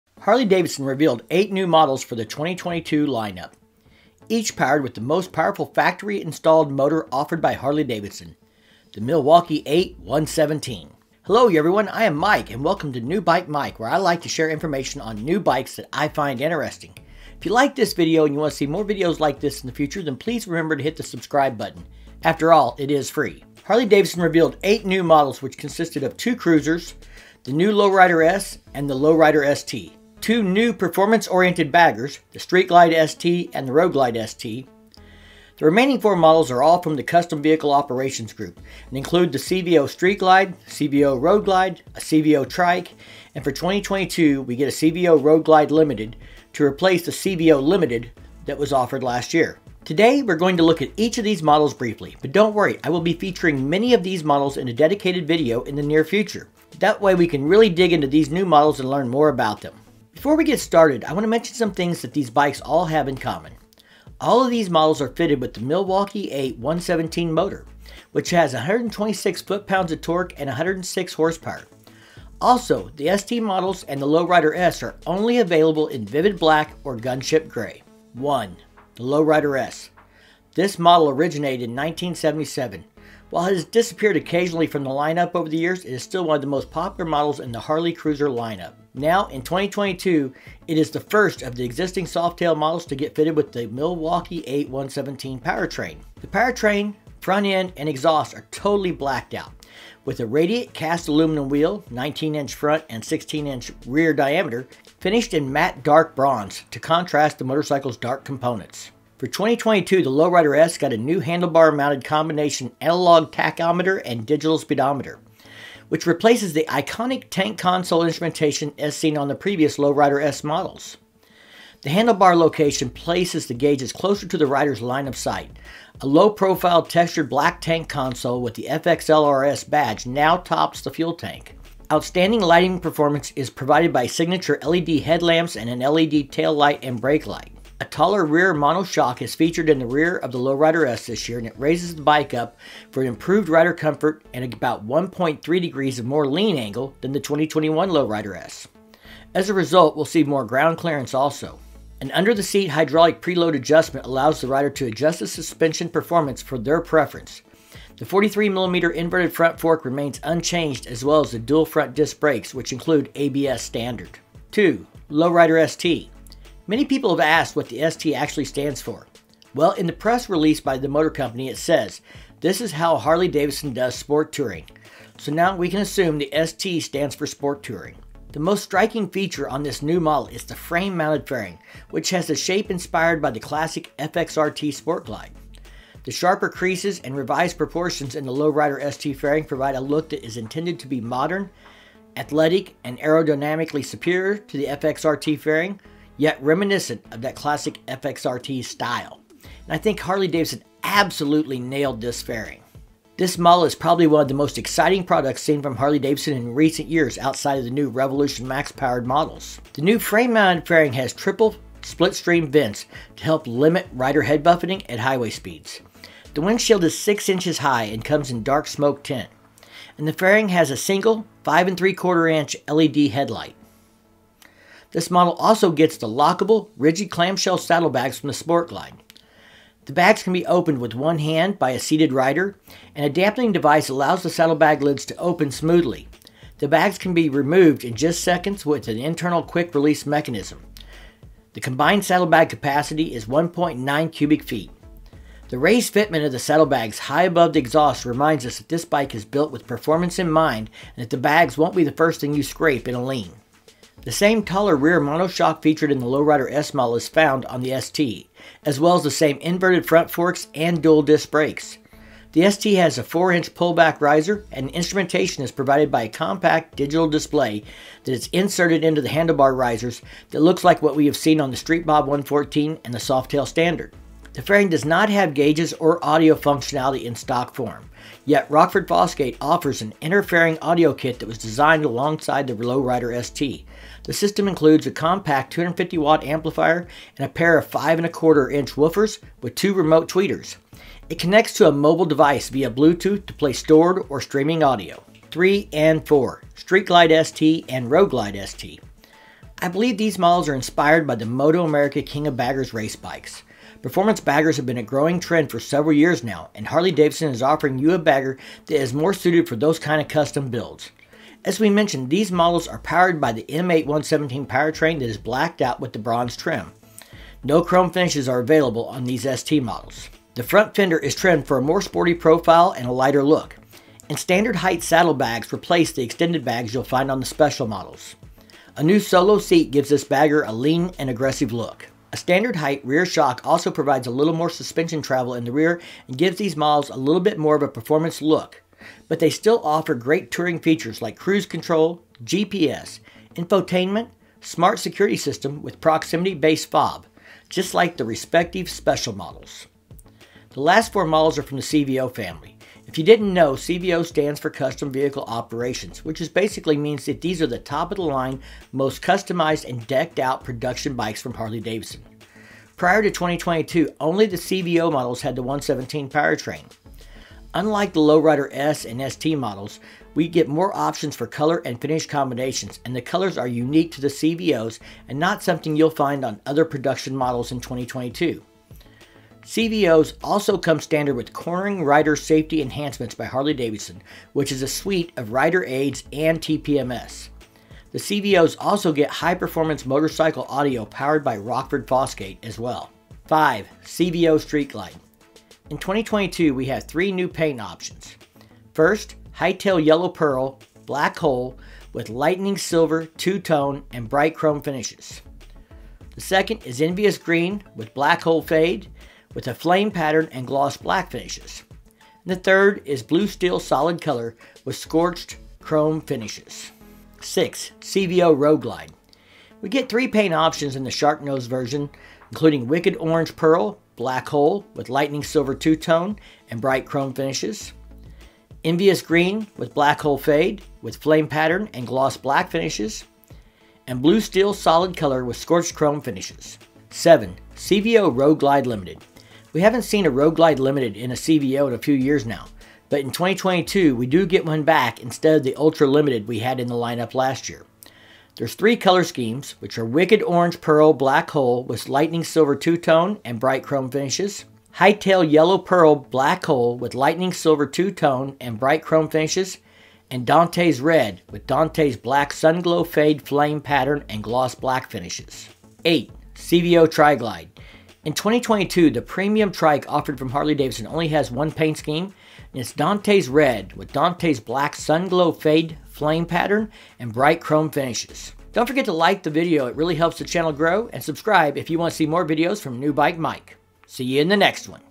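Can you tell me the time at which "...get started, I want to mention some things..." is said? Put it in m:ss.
1:00.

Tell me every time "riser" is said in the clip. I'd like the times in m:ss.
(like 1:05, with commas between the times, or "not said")
4:24, 4:29.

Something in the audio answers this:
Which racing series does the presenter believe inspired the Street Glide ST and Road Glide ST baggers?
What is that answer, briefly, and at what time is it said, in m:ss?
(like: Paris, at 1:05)
King of Baggers, at 5:02.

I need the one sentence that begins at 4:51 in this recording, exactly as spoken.
It connects to a mobile device via Bluetooth to play stored or streaming audio.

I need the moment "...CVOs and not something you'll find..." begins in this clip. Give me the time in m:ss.
6:14.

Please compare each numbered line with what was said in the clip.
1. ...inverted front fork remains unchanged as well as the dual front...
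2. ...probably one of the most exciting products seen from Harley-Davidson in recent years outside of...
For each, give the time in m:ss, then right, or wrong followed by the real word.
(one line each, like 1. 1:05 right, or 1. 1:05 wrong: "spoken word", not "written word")
1. 2:38 right
2. 3:23 right.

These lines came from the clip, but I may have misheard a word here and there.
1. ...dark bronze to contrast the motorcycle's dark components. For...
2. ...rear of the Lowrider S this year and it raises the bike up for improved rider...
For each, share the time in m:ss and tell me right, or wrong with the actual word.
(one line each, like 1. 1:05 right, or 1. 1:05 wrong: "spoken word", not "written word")
1. 1:45 right
2. 2:19 right.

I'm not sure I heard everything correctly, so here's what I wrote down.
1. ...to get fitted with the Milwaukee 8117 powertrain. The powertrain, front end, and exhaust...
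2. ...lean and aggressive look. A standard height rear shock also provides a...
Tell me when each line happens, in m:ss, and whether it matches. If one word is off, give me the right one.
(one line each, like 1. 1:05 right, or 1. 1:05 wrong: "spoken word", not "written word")
1. 1:32 right
2. 5:30 right.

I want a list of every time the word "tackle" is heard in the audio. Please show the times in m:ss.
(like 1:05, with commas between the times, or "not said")
not said.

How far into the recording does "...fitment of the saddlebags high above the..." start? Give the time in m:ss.
4:05.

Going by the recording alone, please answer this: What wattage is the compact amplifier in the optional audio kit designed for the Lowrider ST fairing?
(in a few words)
250 watt.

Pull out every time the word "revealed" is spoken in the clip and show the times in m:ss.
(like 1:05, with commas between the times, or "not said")
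0:00, 0:24.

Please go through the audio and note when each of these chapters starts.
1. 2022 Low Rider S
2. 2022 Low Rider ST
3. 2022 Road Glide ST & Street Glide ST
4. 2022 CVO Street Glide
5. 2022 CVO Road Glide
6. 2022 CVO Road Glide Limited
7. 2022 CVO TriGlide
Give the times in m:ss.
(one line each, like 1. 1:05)
1. 1:18
2. 2:43
3. 4:54
4. 6:32
5. 6:56
6. 7:16
7. 7:45.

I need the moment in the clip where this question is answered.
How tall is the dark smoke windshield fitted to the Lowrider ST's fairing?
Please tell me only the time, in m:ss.
3:36.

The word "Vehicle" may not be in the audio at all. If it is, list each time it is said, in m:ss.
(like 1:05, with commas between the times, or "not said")
0:37, 5:54.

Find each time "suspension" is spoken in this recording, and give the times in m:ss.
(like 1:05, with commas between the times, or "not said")
2:35, 5:34.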